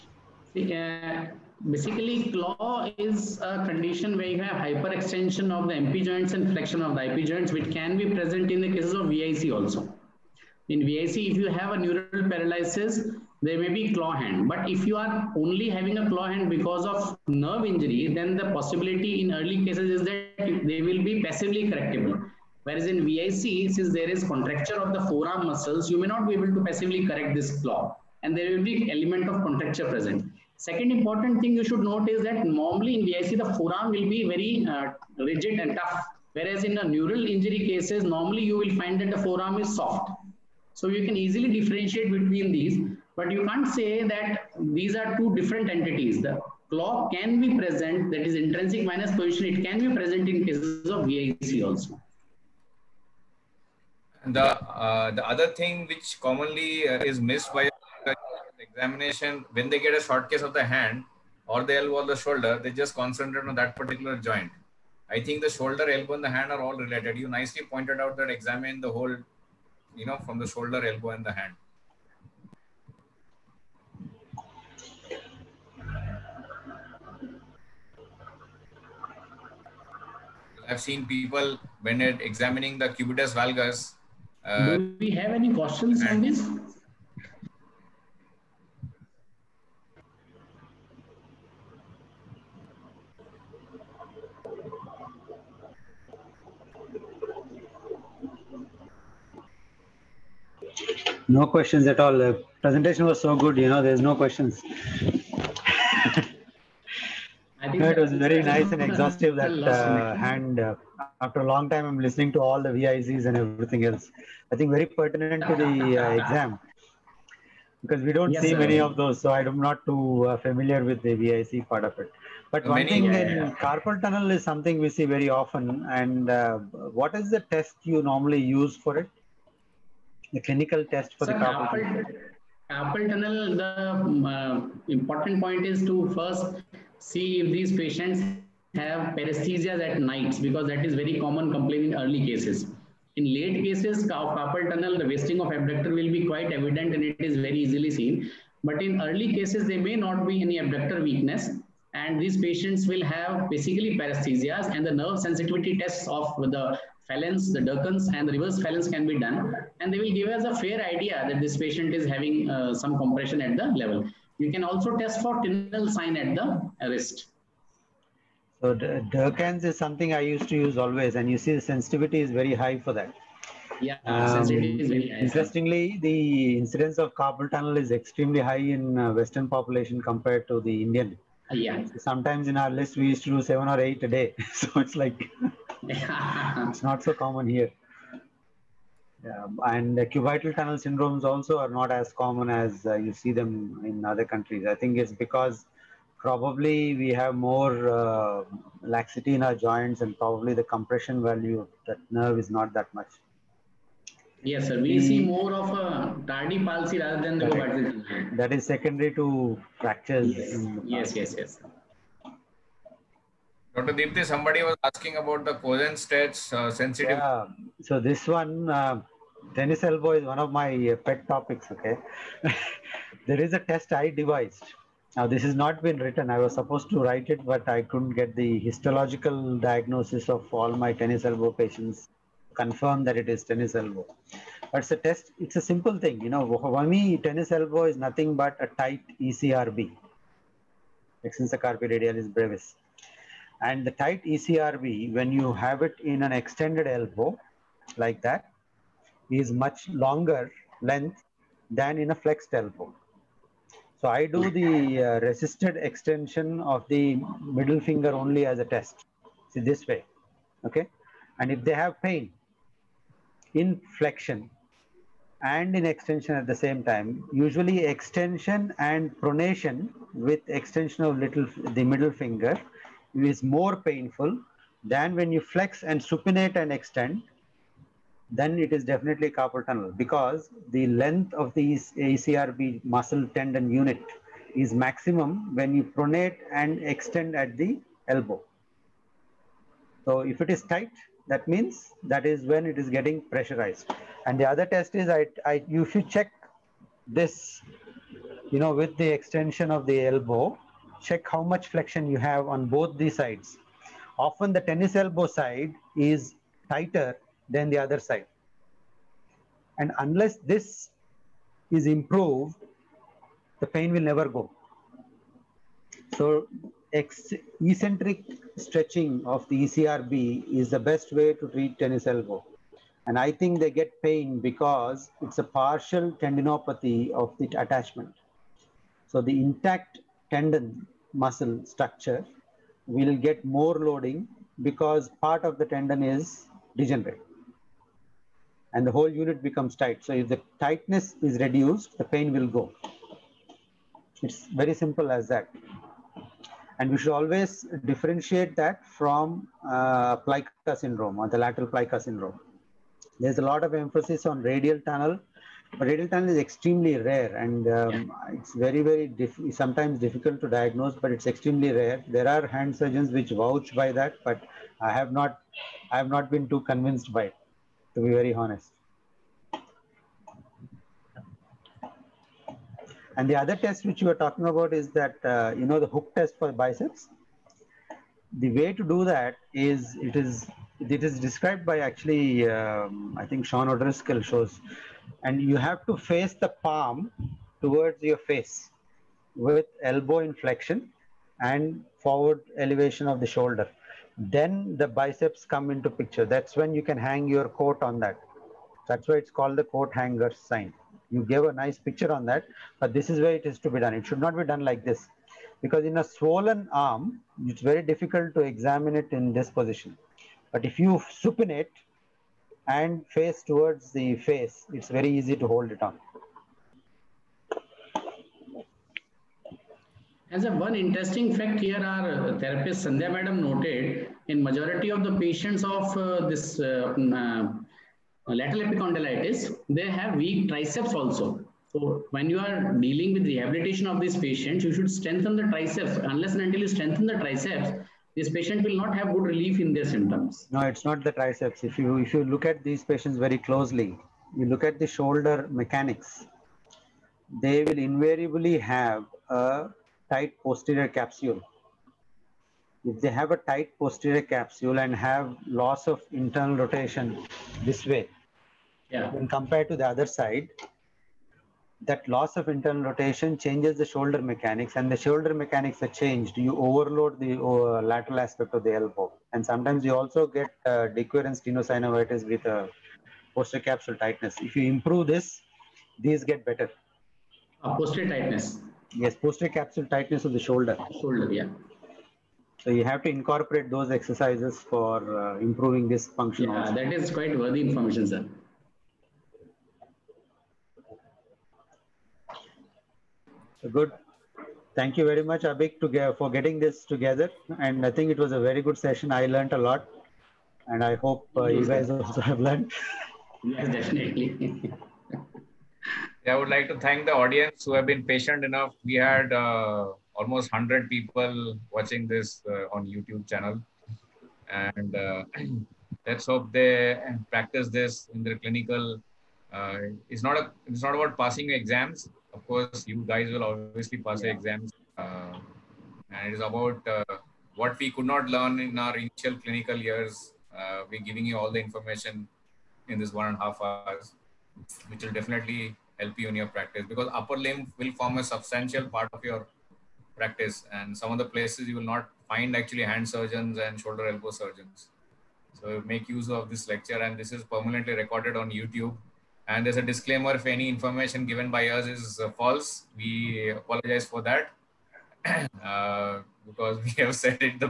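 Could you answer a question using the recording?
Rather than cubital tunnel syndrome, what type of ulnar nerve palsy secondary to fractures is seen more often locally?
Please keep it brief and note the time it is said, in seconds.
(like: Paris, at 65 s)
tardy palsy, at 206 s.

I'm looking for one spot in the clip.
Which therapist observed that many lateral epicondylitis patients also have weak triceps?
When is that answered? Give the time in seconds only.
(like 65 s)
422 s.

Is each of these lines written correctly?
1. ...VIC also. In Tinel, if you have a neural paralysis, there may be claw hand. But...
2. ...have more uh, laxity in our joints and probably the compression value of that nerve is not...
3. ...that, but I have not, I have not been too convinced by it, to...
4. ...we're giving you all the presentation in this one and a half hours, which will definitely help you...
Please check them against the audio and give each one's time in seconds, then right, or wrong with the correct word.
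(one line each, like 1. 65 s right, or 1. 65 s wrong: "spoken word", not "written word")
1. 9 s wrong: "VIC", not "Tinel"
2. 197 s right
3. 363 s right
4. 530 s wrong: "information", not "presentation".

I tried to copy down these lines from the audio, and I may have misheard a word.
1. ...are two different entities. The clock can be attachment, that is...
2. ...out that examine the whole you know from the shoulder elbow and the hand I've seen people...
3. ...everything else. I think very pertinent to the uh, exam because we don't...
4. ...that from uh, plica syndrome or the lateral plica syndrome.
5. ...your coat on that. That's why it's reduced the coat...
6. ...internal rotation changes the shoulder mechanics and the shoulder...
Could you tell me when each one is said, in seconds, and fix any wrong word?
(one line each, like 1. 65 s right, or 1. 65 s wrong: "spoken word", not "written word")
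1. 44 s wrong: "present", not "attachment"
2. 67 s right
3. 113 s right
4. 348 s right
5. 397 s wrong: "called", not "reduced"
6. 462 s right.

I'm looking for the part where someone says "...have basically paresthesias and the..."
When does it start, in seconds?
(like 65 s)
153 s.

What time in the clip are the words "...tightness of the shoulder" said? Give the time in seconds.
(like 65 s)
479 s.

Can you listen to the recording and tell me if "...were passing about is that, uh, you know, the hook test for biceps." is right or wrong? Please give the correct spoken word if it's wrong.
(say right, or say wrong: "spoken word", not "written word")
wrong: "talking", not "passing".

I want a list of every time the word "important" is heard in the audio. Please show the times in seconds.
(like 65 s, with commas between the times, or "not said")
30 s, 134 s.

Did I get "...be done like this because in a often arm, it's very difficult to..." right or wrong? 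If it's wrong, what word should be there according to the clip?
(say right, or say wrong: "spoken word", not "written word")
wrong: "swollen", not "often".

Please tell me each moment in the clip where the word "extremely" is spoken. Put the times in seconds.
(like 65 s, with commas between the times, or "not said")
177 s, 356 s, 361 s.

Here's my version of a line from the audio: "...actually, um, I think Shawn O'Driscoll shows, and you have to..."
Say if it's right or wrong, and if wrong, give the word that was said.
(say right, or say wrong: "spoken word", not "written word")
right.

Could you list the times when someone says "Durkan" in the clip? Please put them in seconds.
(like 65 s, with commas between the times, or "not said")
157 s, 168 s.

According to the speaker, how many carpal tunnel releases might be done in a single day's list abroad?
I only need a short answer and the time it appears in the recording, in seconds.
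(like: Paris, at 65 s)
7 or 8, at 183 s.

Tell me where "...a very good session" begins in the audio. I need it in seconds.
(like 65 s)
498 s.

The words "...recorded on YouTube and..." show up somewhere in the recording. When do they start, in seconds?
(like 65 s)
547 s.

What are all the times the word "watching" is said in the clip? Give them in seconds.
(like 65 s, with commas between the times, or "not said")
511 s.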